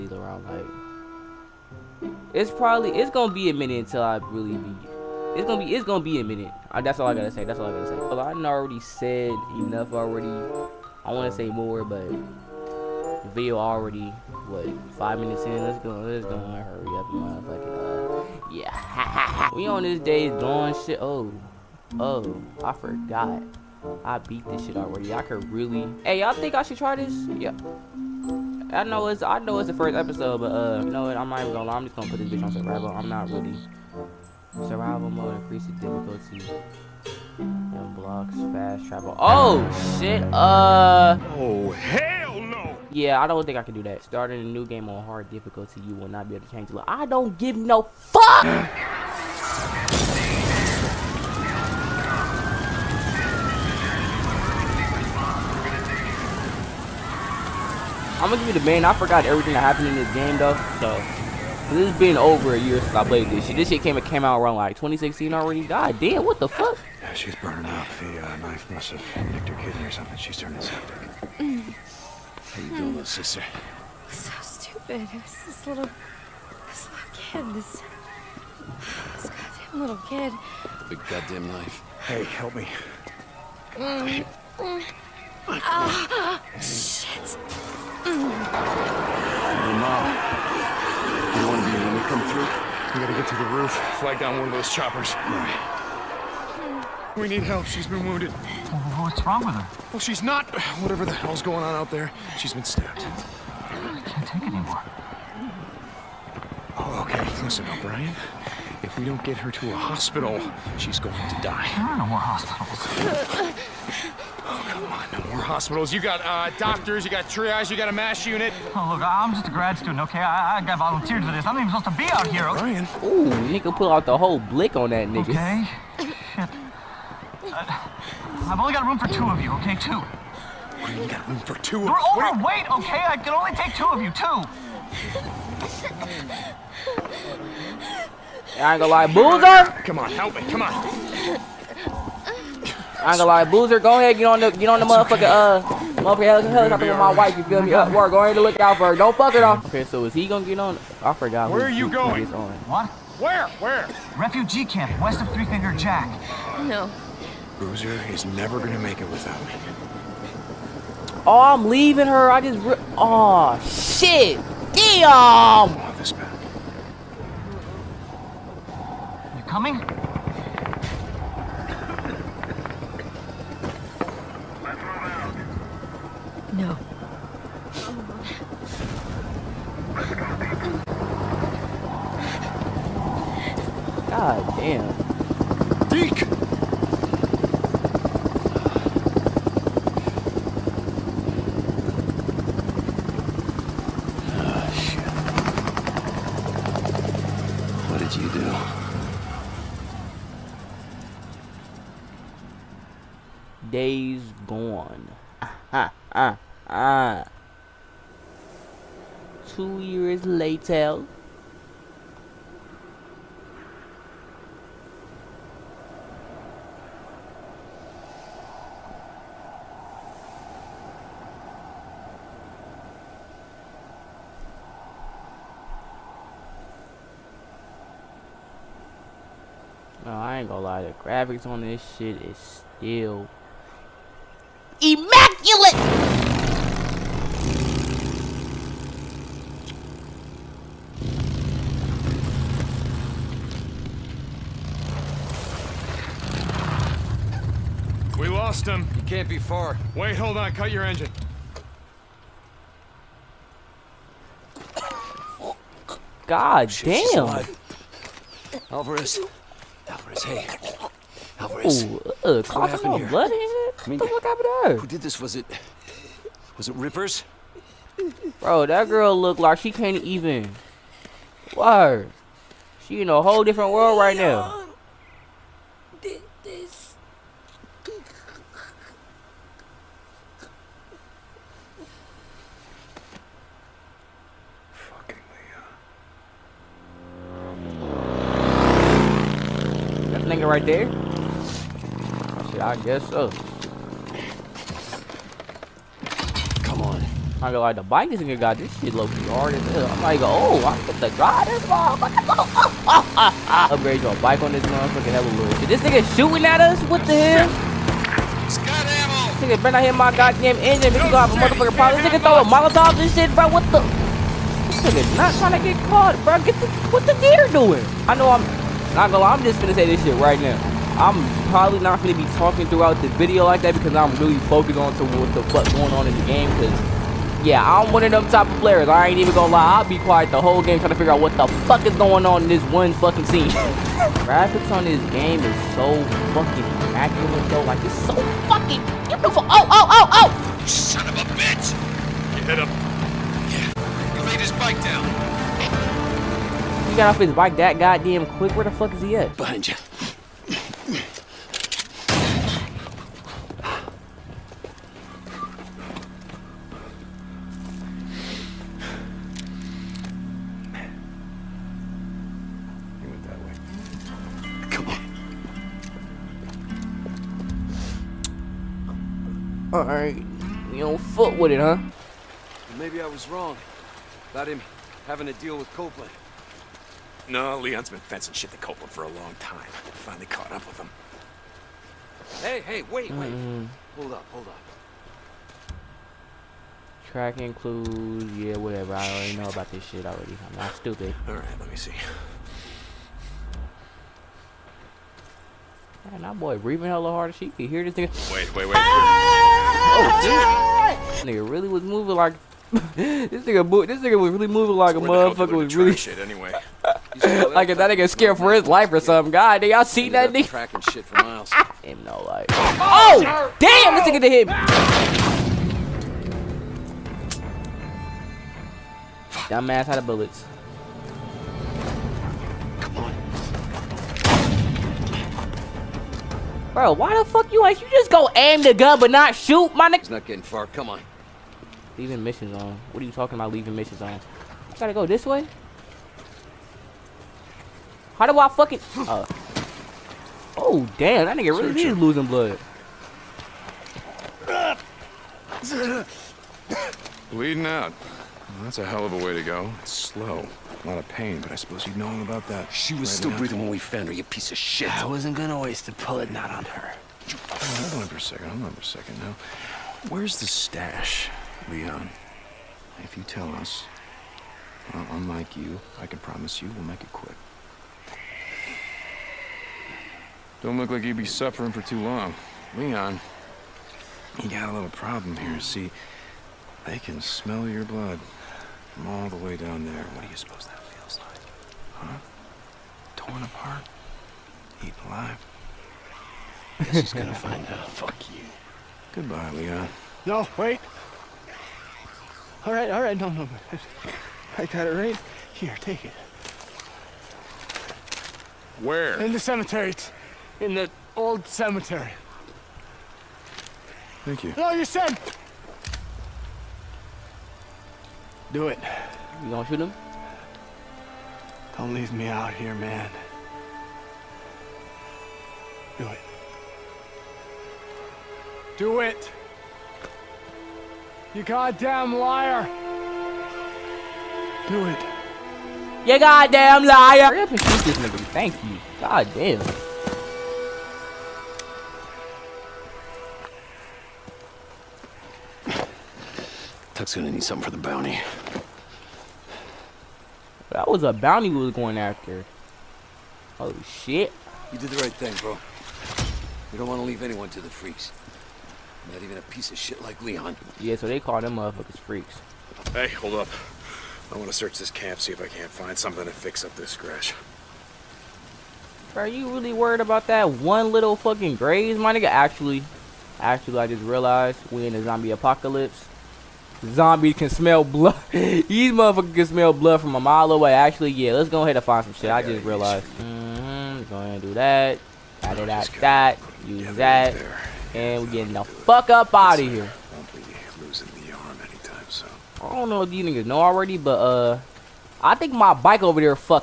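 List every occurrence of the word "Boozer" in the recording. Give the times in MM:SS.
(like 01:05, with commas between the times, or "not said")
02:19, 02:23, 02:37.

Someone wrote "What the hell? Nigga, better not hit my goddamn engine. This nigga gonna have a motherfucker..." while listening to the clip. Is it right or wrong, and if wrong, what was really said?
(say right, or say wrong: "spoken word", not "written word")
right.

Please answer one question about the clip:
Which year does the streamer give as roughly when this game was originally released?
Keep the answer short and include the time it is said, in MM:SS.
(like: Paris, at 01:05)
2016, at 01:04.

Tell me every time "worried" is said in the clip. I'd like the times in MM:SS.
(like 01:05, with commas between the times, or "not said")
09:19.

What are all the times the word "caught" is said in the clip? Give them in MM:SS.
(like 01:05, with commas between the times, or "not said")
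05:15, 06:20.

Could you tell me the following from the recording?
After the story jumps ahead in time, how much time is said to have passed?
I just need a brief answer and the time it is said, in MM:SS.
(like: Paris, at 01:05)
2 years, at 03:29.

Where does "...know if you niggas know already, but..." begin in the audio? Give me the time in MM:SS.
09:42.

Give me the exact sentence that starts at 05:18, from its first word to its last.
I know I'm not gonna lie, I'm just gonna say this shit right now.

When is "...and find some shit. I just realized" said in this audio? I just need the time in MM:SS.
09:31.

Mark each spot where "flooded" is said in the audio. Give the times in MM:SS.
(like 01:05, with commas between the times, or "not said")
not said.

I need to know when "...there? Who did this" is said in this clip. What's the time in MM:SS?
04:24.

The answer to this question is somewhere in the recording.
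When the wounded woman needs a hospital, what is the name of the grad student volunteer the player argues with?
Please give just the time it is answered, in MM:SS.
01:47.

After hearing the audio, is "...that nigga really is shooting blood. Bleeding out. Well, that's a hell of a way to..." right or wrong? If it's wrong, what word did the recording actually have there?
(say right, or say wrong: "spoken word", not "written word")
wrong: "losing", not "shooting".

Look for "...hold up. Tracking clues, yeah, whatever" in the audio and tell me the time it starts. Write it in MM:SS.
06:24.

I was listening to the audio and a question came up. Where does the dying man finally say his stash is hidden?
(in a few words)
The old cemetery.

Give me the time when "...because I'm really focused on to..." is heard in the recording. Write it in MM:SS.
05:23.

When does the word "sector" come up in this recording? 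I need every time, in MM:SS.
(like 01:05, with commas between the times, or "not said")
not said.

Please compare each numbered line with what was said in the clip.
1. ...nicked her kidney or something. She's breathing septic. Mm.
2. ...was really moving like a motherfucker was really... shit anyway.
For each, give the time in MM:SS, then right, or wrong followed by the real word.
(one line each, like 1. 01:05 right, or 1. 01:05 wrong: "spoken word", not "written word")
1. 01:09 wrong: "turning", not "breathing"
2. 06:44 right.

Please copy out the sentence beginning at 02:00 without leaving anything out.
I, I got volunteered for this.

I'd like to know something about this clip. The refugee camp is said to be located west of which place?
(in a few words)
Three Finger Jack.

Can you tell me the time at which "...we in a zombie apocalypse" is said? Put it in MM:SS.
09:24.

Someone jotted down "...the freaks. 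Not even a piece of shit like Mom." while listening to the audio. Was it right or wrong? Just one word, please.
wrong.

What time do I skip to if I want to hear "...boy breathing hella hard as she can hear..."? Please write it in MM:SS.
06:36.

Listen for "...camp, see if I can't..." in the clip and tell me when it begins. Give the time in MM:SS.
09:14.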